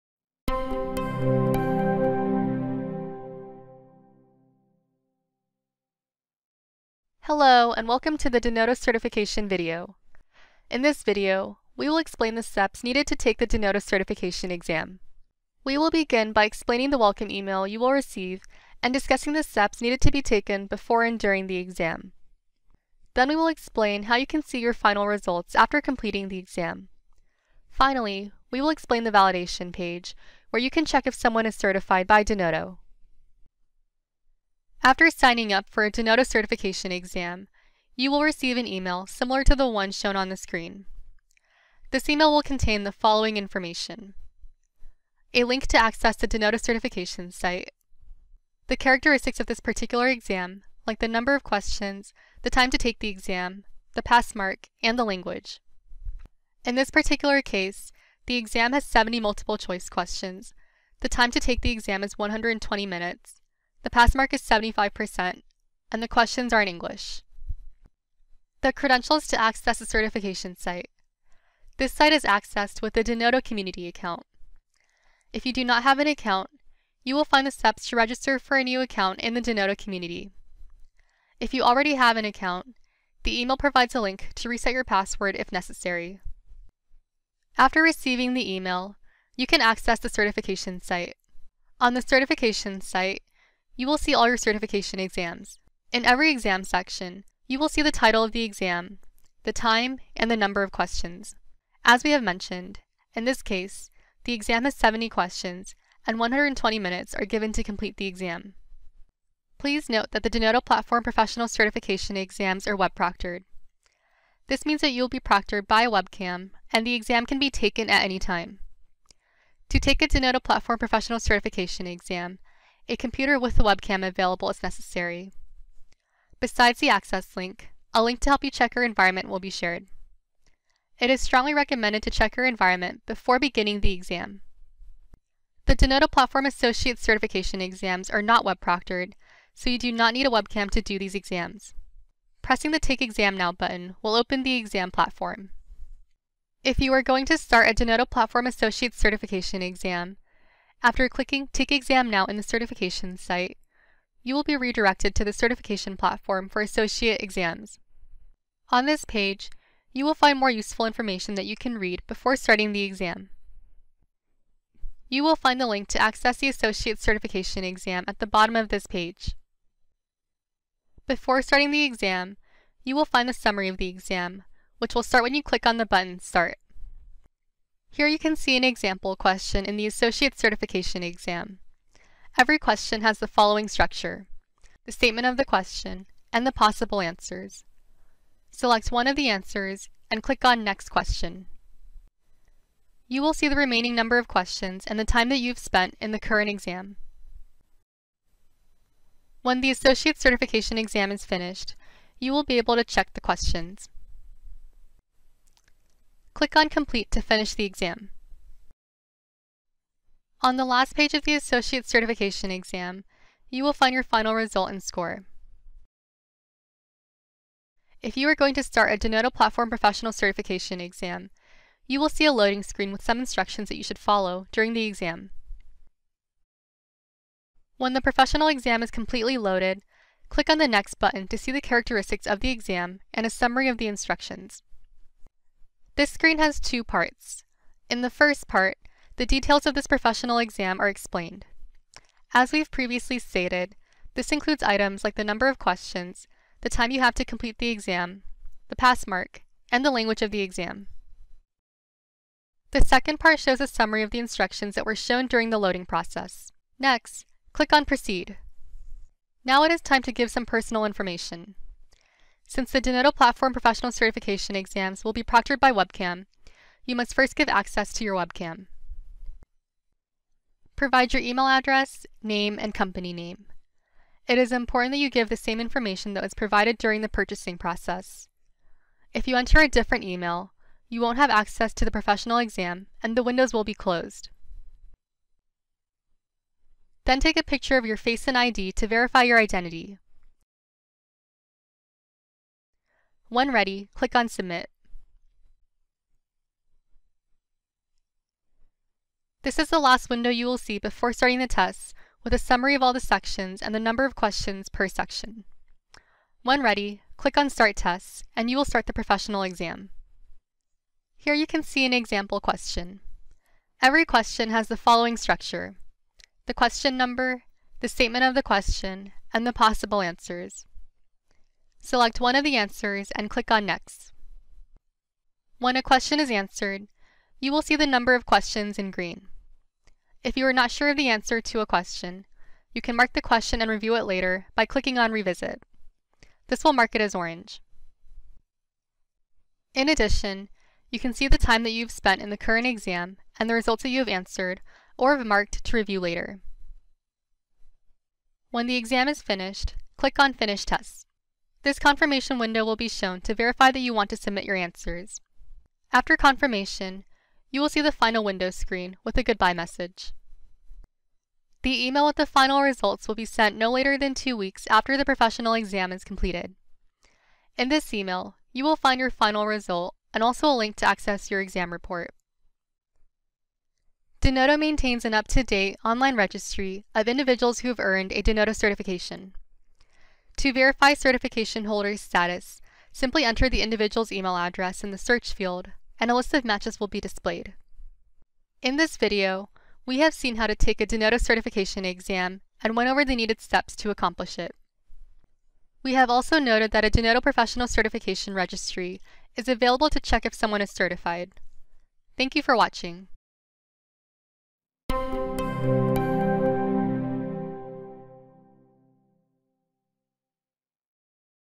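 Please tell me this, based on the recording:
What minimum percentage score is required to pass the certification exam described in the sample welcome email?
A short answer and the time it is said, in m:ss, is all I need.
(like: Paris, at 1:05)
75%, at 1:04.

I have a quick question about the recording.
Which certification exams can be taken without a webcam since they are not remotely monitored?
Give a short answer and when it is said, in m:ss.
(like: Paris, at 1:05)
Associate Certification exams, at 2:16.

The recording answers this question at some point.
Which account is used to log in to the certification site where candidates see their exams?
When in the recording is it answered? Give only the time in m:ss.
1:13.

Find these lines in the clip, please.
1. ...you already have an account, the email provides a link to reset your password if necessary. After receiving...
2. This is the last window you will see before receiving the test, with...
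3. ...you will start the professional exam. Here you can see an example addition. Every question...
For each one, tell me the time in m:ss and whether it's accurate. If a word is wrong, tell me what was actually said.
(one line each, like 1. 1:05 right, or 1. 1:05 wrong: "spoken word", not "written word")
1. 1:21 right
2. 4:59 wrong: "starting", not "receiving"
3. 5:08 wrong: "question", not "addition".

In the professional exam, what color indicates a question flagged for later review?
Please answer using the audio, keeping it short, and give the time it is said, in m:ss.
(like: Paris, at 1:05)
orange, at 5:37.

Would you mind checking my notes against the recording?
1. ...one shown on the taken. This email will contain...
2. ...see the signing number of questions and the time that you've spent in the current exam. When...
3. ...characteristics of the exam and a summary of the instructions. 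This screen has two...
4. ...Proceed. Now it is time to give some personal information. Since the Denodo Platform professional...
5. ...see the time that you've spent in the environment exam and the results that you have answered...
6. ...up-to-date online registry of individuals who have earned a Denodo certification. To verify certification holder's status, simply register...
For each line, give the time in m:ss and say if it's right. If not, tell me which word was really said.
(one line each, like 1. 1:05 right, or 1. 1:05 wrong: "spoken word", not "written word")
1. 0:39 wrong: "screen", not "taken"
2. 3:13 wrong: "remaining", not "signing"
3. 3:51 right
4. 4:17 right
5. 5:41 wrong: "current", not "environment"
6. 6:15 wrong: "enter", not "register".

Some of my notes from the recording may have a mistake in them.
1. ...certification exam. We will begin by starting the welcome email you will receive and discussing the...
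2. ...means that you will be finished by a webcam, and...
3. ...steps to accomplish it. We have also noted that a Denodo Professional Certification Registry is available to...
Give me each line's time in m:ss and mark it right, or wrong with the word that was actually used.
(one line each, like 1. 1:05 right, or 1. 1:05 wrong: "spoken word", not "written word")
1. 0:13 wrong: "explaining", not "starting"
2. 1:54 wrong: "proctored", not "finished"
3. 6:33 right.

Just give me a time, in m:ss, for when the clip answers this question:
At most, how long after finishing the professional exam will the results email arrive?
6:04.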